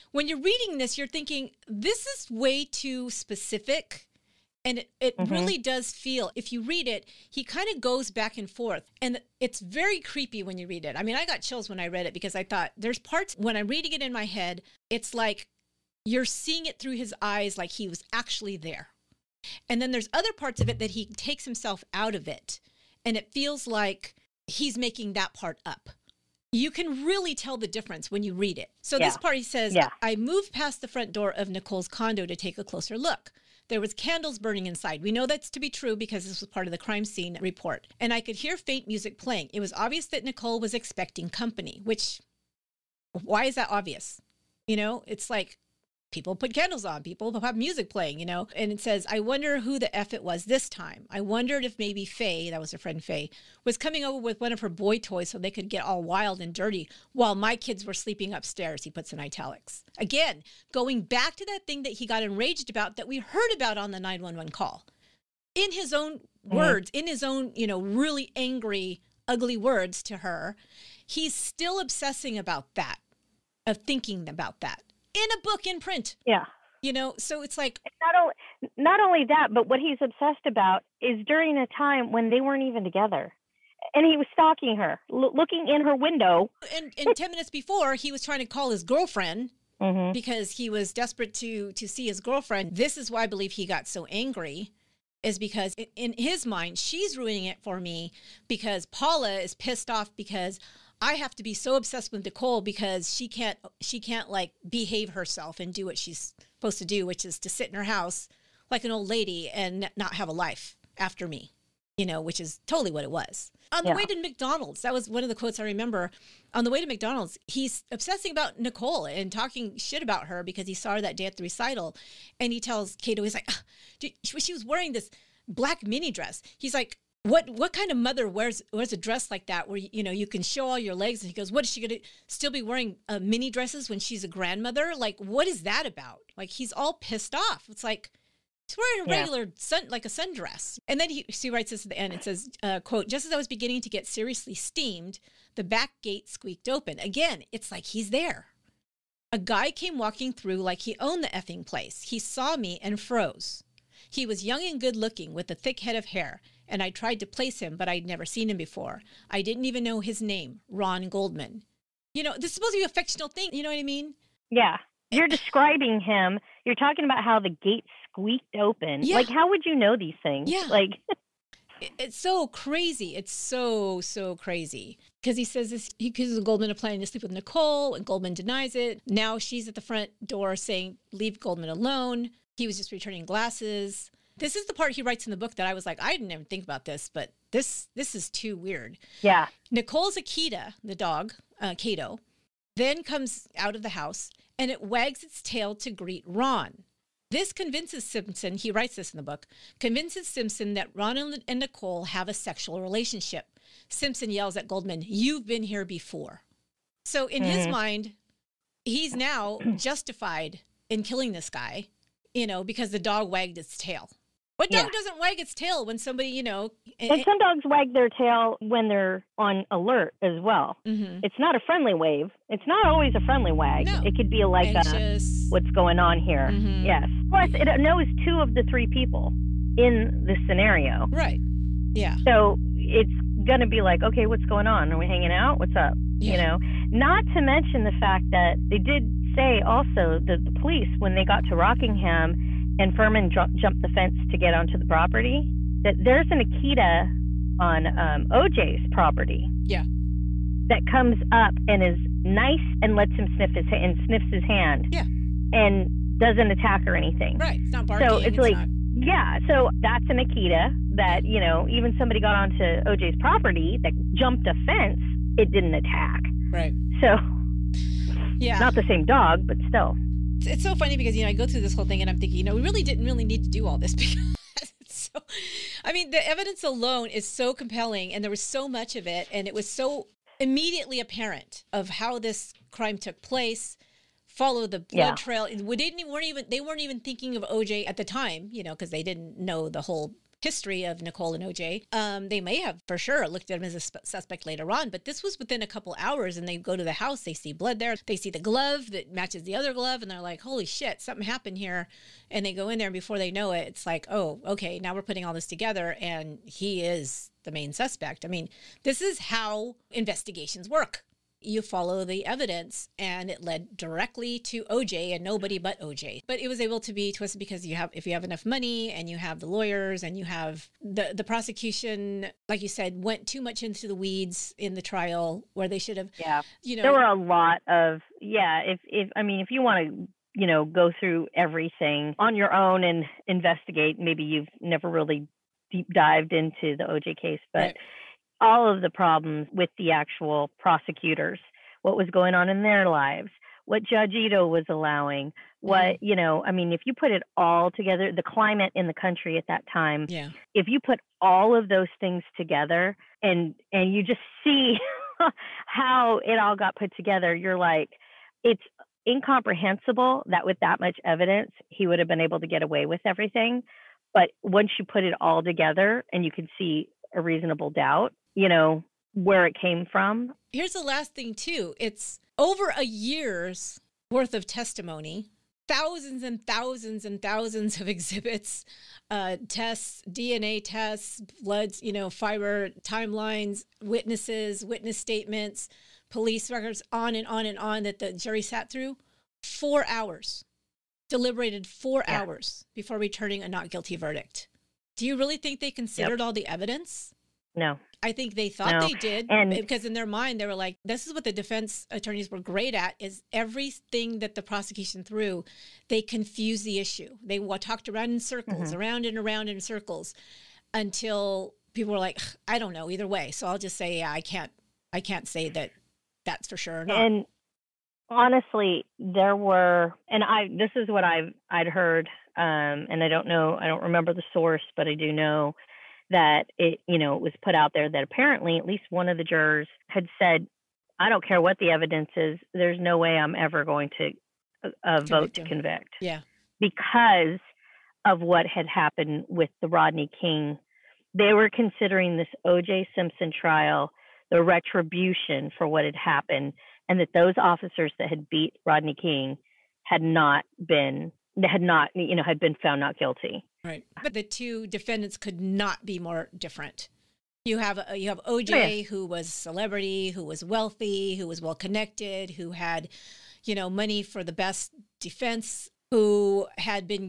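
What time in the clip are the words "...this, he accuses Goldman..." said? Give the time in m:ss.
2:55.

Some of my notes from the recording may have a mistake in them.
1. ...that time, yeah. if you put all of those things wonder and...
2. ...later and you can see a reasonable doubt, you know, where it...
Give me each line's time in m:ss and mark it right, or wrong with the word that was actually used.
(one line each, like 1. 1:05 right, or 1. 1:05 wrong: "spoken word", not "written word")
1. 5:49 wrong: "together", not "wonder"
2. 6:05 wrong: "together", not "later".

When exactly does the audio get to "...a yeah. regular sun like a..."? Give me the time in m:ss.
2:19.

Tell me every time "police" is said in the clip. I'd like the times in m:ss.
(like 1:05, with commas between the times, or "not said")
4:00, 6:26.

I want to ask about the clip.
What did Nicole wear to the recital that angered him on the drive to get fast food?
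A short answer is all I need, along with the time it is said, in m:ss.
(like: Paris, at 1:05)
black mini dress, at 2:05.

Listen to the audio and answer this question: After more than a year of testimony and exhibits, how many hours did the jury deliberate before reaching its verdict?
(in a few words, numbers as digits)
4.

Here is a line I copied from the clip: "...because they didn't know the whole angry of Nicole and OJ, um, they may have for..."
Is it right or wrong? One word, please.
wrong.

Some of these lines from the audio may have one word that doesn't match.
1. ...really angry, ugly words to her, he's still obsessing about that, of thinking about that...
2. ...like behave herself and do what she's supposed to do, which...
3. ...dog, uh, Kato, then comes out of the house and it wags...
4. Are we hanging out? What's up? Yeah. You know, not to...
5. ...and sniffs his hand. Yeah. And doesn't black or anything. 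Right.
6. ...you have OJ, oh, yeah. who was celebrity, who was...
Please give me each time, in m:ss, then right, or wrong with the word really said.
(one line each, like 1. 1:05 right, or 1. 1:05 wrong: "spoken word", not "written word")
1. 1:07 right
2. 1:44 right
3. 3:10 right
4. 3:54 right
5. 4:13 wrong: "attack", not "black"
6. 7:37 right.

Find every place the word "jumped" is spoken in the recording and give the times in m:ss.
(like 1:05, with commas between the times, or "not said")
4:03, 4:24.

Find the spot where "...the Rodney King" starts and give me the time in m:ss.
7:19.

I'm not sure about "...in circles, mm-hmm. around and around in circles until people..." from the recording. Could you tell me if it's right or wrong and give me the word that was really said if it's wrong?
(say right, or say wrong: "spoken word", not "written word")
right.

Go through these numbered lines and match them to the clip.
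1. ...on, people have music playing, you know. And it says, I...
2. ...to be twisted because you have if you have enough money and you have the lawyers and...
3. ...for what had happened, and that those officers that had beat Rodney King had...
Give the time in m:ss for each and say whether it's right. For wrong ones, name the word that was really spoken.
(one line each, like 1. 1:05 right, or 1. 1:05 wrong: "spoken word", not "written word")
1. 0:46 right
2. 5:16 right
3. 7:25 right.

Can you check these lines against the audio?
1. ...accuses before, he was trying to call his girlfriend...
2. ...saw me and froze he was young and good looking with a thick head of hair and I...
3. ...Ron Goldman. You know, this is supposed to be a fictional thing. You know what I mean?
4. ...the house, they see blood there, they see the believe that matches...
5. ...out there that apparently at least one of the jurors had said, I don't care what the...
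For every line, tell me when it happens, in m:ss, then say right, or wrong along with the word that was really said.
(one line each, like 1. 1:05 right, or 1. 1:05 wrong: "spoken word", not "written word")
1. 1:27 wrong: "minutes", not "accuses"
2. 2:32 right
3. 2:40 right
4. 4:56 wrong: "glove", not "believe"
5. 7:07 right.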